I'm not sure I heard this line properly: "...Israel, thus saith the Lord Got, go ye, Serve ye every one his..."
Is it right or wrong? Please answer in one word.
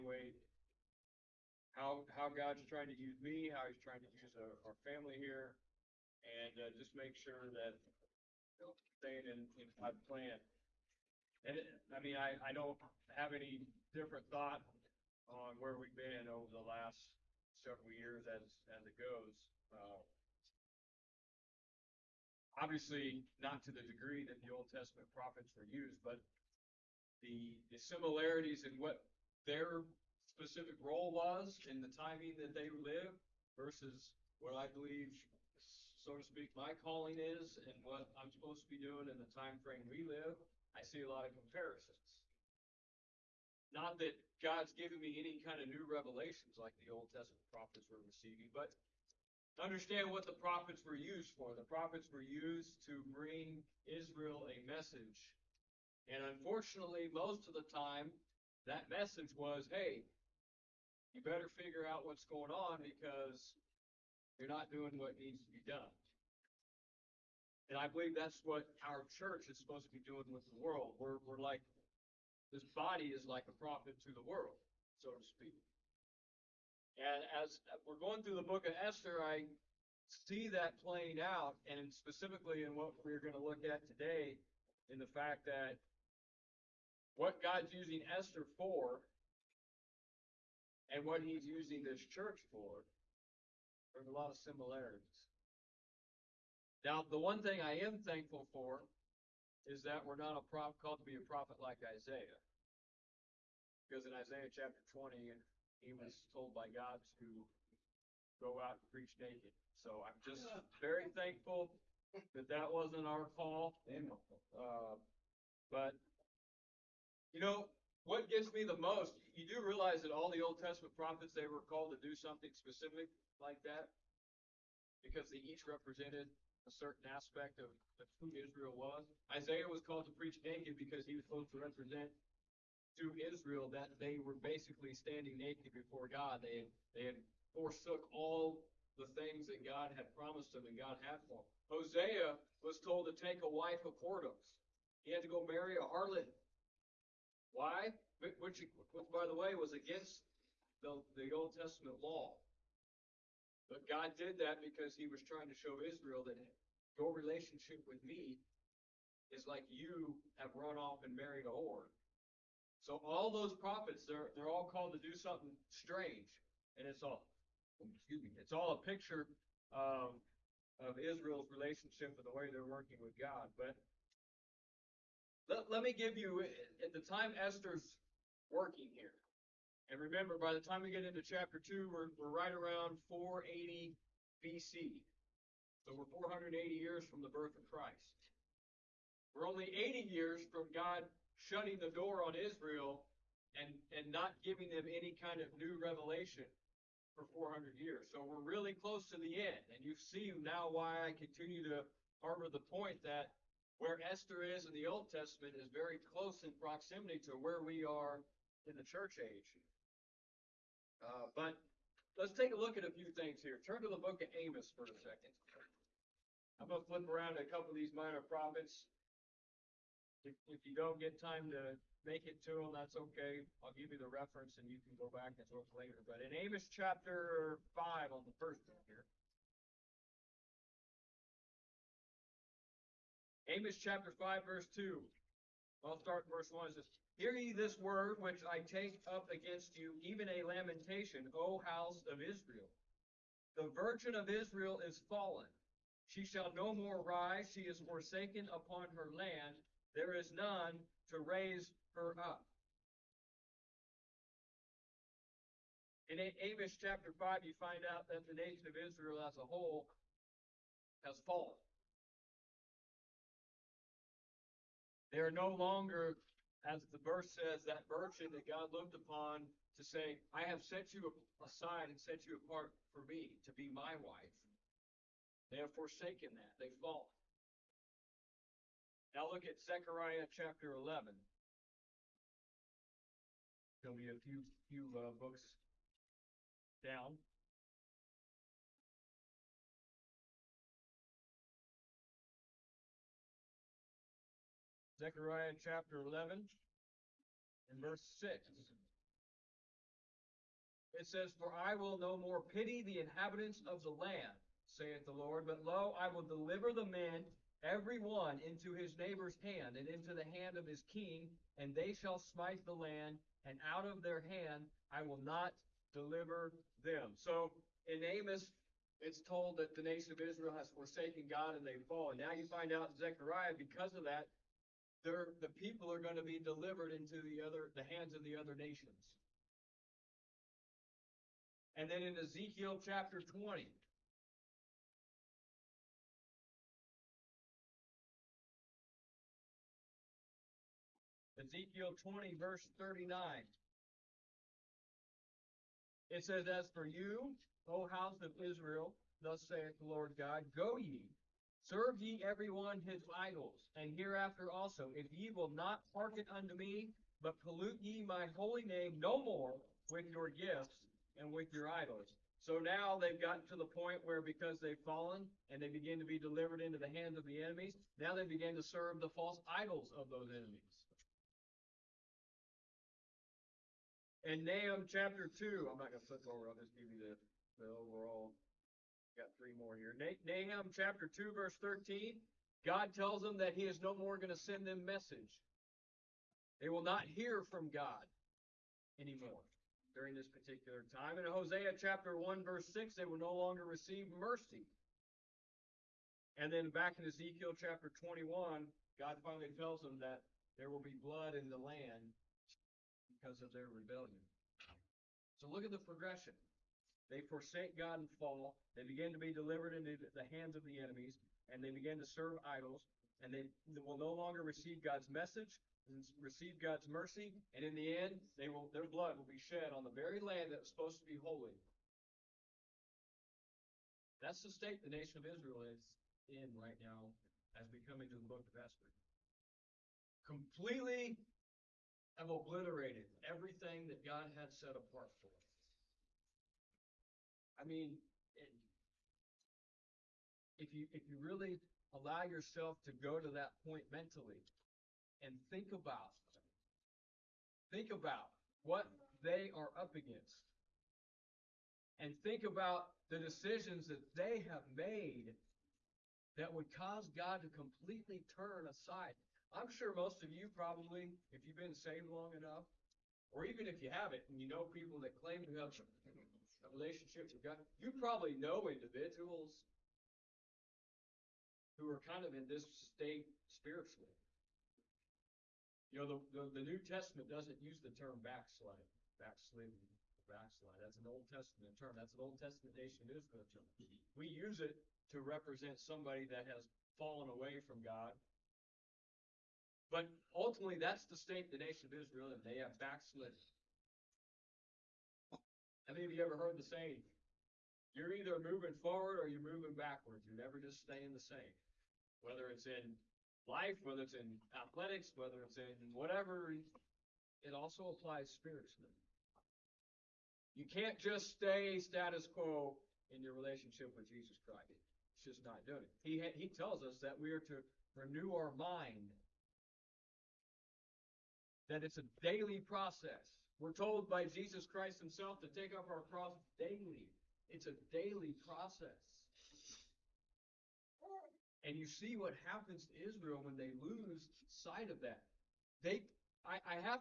wrong.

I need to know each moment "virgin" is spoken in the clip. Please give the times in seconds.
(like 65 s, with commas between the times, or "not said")
243 s, 267 s.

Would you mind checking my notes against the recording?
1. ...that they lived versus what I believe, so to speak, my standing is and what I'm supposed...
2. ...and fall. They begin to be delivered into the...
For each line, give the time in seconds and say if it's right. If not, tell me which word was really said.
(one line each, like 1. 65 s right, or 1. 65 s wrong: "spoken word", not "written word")
1. 32 s wrong: "calling", not "standing"
2. 408 s right.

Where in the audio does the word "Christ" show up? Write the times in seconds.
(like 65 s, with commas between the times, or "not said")
187 s, 514 s, 524 s.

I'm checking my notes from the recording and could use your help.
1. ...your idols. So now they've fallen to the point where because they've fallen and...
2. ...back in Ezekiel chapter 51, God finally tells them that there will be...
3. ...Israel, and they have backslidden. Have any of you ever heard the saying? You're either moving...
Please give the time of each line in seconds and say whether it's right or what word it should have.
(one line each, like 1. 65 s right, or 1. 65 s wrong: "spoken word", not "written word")
1. 361 s wrong: "gotten", not "fallen"
2. 396 s wrong: "21", not "51"
3. 491 s right.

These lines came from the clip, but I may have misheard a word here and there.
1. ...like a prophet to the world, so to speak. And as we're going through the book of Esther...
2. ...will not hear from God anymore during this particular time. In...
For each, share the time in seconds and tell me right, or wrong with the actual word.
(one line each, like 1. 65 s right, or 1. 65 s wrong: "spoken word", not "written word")
1. 73 s right
2. 386 s right.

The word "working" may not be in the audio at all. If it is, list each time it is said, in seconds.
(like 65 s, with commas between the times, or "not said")
172 s, 178 s.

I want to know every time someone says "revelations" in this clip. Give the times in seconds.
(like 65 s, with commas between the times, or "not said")
45 s, 195 s.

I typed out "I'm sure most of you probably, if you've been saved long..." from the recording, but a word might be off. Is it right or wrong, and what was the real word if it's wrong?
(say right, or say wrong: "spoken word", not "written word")
right.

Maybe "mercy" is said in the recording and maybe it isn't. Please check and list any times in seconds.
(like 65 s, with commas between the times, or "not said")
394 s, 416 s.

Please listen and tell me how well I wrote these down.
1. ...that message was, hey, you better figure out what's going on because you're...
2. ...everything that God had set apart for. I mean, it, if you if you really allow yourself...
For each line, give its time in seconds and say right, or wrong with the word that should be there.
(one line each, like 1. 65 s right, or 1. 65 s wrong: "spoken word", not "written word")
1. 58 s right
2. 433 s right.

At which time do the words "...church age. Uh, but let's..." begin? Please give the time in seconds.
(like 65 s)
208 s.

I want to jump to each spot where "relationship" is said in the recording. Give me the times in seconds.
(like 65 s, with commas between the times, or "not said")
157 s, 171 s, 466 s, 513 s.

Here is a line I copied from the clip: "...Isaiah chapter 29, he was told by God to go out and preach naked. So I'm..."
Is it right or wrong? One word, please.
wrong.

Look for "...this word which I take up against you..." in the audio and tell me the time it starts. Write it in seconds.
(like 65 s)
237 s.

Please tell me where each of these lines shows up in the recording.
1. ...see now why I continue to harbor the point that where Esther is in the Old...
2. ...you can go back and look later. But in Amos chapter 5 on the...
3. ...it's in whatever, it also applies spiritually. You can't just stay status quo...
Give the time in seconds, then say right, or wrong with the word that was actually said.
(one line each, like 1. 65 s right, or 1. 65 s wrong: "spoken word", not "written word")
1. 199 s right
2. 224 s right
3. 505 s right.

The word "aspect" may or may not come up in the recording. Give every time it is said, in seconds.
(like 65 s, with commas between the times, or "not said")
127 s.